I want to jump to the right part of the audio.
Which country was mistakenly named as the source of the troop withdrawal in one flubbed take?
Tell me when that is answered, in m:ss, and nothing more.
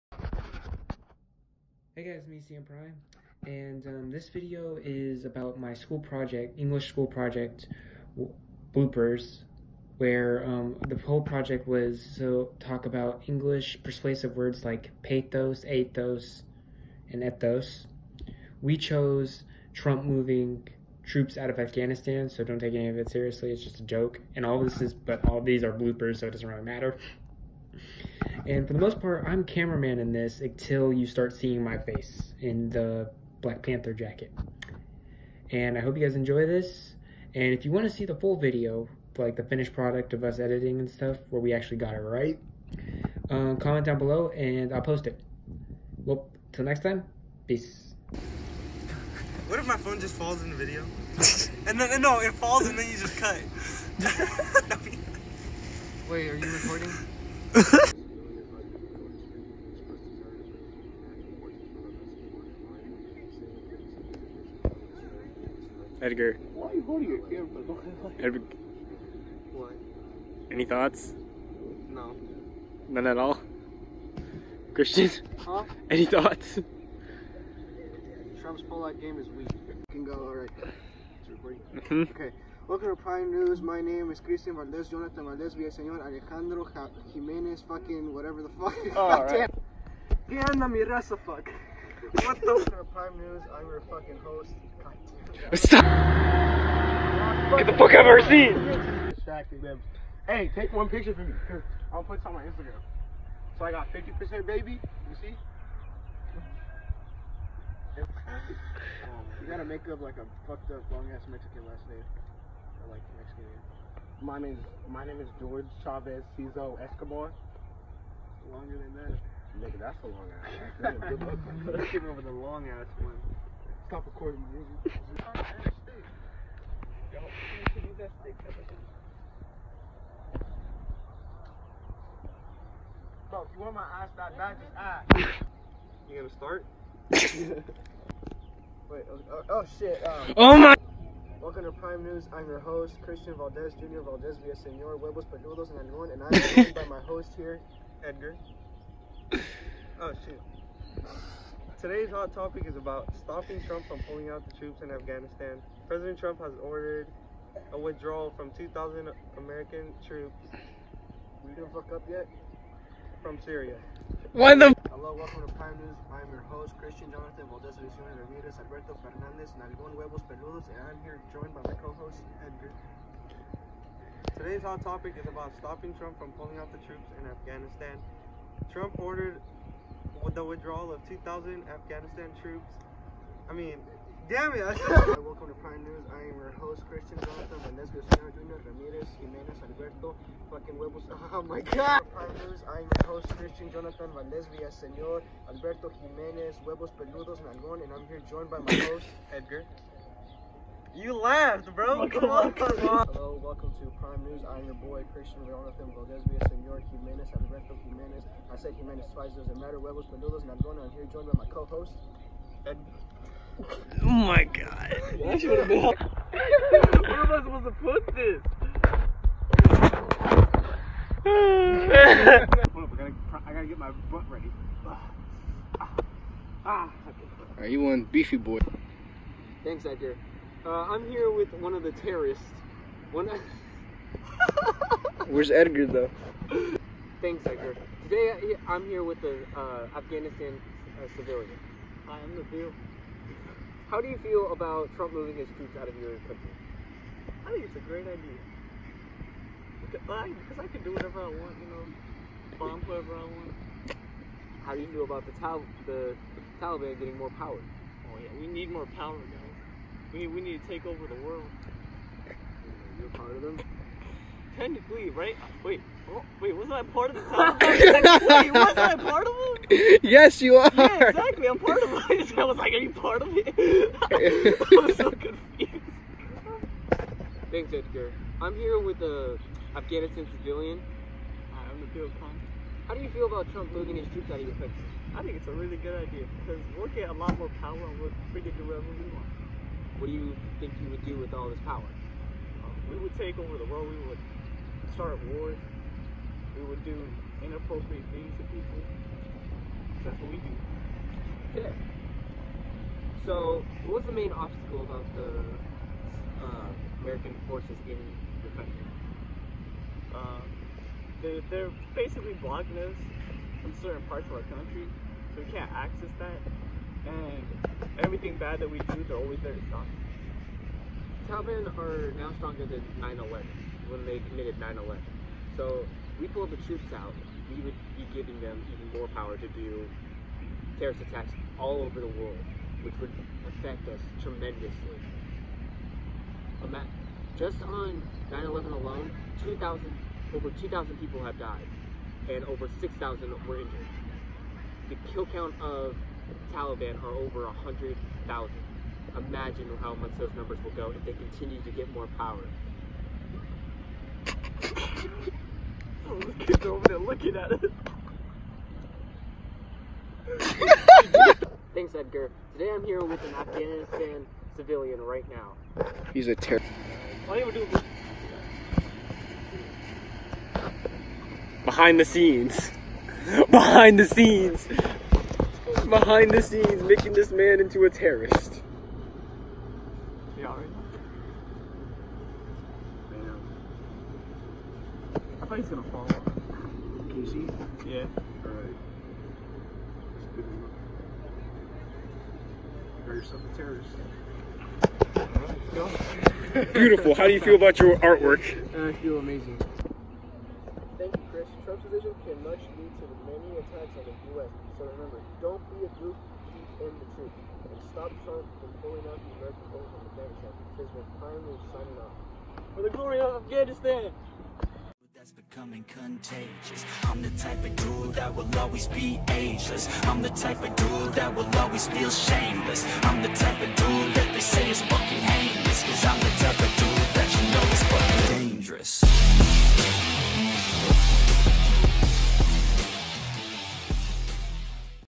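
2:43.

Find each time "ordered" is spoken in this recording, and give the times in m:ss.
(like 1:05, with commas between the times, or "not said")
2:36, 2:58.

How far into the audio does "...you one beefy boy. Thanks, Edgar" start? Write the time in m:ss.
3:47.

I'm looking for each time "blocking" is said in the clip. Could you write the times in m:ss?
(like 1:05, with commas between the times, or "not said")
5:12.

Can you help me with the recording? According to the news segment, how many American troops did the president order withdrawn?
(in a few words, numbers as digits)
2,000.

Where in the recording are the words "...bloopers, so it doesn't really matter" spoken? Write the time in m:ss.
0:25.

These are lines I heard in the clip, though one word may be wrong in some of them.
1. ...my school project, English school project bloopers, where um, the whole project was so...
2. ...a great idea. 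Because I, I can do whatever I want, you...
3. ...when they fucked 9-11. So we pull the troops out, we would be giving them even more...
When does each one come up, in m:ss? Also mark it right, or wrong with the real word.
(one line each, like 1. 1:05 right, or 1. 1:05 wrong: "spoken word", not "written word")
1. 0:05 right
2. 4:07 right
3. 5:23 wrong: "committed", not "fucked".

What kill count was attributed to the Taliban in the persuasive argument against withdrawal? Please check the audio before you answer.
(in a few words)
Over 100,000.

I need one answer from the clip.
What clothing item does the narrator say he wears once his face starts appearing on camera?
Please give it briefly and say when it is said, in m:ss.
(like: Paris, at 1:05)
Black Panther jacket, at 0:33.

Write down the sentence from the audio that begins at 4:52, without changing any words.
Um, we would take over the world.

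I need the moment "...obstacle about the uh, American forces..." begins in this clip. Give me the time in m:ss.
5:04.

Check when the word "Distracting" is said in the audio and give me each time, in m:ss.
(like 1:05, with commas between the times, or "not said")
1:39.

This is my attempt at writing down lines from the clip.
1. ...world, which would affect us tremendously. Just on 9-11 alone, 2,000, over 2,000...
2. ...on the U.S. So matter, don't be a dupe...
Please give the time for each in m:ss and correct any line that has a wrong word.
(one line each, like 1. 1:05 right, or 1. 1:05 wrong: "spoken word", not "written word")
1. 5:32 right
2. 6:43 wrong: "remember", not "matter".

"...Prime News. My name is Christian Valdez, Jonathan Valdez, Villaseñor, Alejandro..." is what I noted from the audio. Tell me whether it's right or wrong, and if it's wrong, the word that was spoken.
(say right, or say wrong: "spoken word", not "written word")
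right.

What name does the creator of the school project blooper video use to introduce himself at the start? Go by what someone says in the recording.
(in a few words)
CM Prime.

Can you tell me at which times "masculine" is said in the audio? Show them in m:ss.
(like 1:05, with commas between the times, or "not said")
not said.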